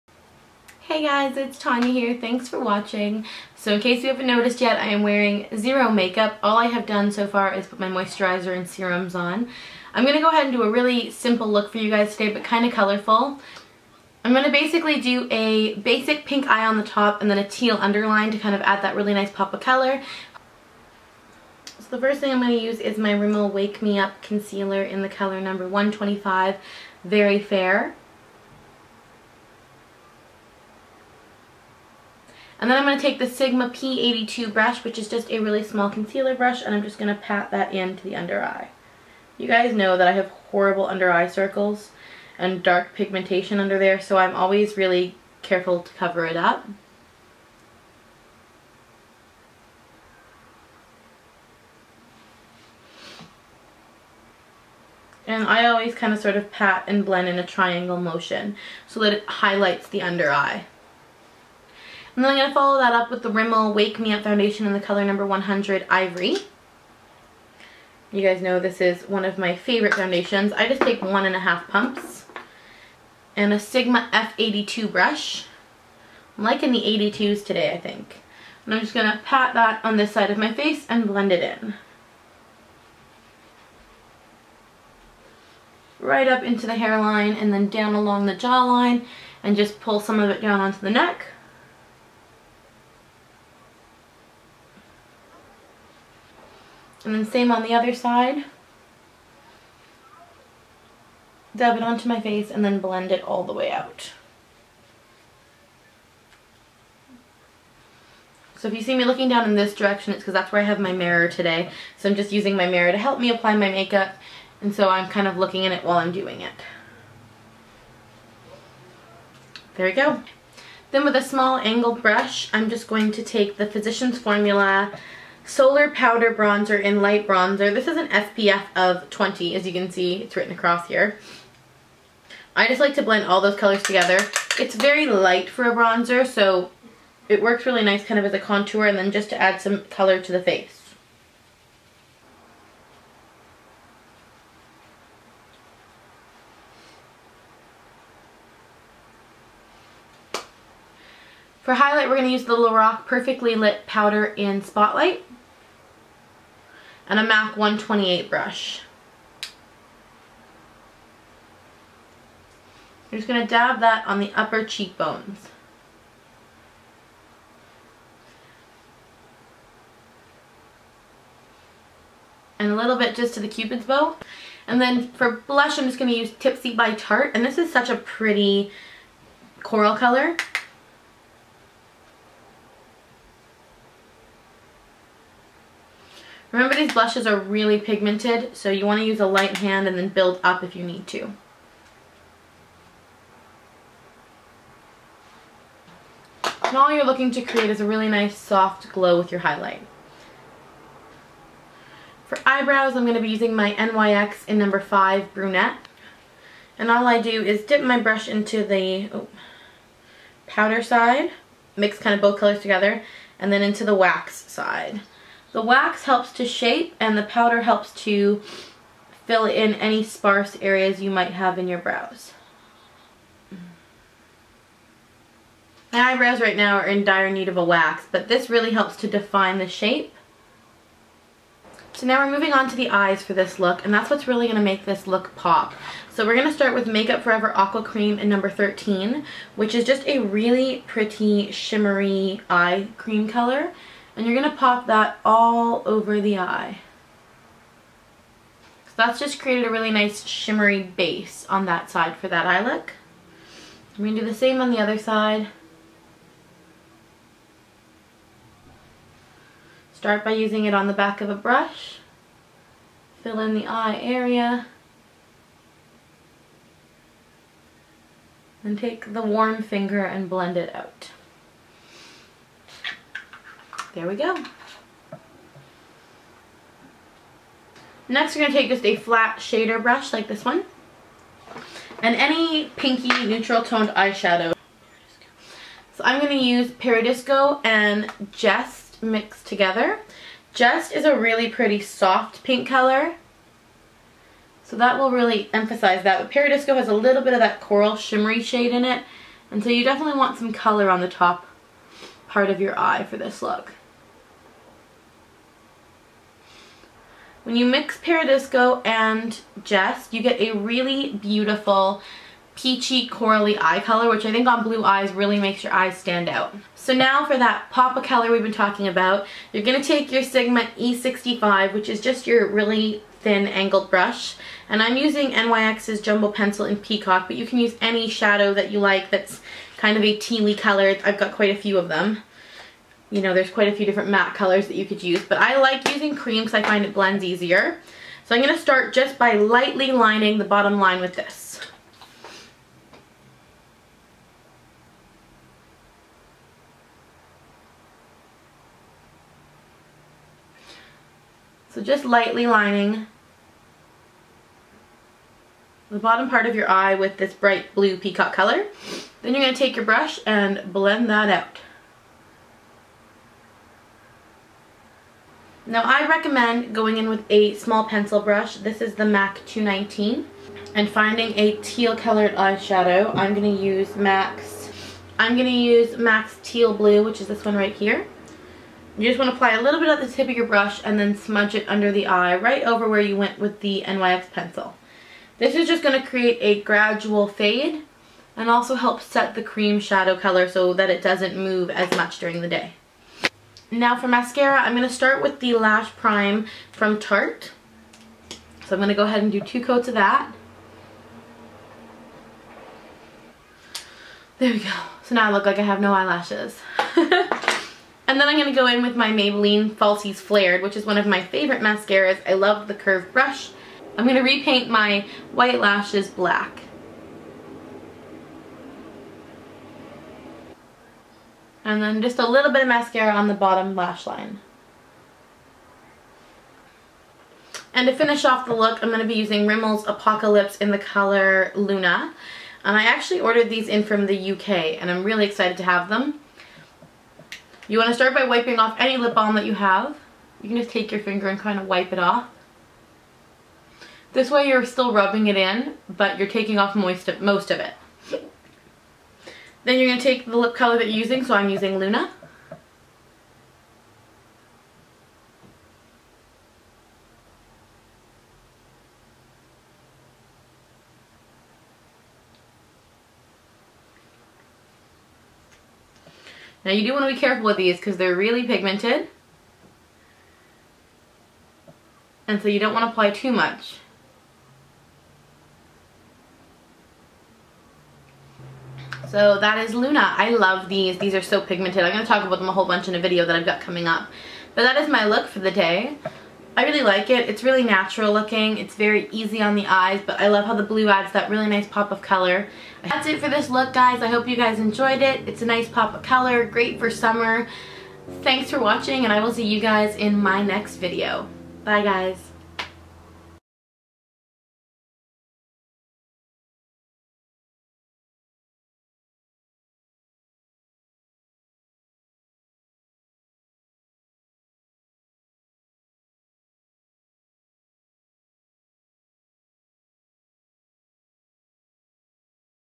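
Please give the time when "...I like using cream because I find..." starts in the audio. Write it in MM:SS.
05:35.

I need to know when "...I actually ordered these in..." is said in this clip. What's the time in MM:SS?
07:12.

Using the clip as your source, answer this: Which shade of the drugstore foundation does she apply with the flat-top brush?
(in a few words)
100 Ivory.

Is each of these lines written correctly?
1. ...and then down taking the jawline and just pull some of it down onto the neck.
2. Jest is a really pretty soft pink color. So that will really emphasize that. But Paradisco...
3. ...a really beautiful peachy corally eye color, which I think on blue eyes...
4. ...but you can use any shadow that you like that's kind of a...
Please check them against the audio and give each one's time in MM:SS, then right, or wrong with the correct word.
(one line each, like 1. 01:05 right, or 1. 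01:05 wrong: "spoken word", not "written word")
1. 01:27 wrong: "along", not "taking"
2. 04:50 right
3. 05:10 right
4. 05:27 right.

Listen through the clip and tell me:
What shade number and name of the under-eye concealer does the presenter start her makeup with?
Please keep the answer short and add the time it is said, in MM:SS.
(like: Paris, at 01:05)
125 Very Fair, at 00:25.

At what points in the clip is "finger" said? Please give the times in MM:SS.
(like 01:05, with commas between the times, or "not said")
04:29, 07:21.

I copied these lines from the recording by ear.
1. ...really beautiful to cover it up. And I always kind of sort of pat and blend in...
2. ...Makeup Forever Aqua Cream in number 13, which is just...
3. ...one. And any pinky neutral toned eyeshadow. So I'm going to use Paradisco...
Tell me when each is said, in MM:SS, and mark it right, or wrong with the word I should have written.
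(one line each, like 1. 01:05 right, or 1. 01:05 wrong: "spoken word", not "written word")
1. 00:44 wrong: "careful", not "beautiful"
2. 03:56 right
3. 04:40 right.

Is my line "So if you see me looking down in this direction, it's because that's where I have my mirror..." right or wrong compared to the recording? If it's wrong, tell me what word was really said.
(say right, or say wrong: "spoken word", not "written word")
right.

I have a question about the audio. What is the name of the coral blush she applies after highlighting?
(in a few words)
Tipsy.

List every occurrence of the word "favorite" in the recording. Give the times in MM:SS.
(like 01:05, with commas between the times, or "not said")
01:09, 06:51.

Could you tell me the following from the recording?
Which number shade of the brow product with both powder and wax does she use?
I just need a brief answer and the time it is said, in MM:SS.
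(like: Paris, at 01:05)
5 Brunette, at 03:24.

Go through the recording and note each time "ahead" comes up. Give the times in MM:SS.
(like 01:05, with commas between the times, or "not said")
00:10, 06:39.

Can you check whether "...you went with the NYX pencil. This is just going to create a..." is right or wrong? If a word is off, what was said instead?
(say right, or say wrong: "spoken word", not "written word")
right.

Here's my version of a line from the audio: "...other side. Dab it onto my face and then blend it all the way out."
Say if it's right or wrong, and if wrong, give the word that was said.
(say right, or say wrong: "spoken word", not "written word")
right.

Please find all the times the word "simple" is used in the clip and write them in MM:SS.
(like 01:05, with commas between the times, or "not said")
00:11.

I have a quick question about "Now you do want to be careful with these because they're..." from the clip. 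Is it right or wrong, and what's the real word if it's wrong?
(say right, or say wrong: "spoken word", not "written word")
right.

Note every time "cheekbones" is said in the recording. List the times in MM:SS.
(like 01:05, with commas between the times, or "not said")
02:44.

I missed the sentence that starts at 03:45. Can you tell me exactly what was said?
My eyebrows right now are in dire need of a wax, but this really helps to define the shape.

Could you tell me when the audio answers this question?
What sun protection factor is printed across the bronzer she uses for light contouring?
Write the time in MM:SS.
02:09.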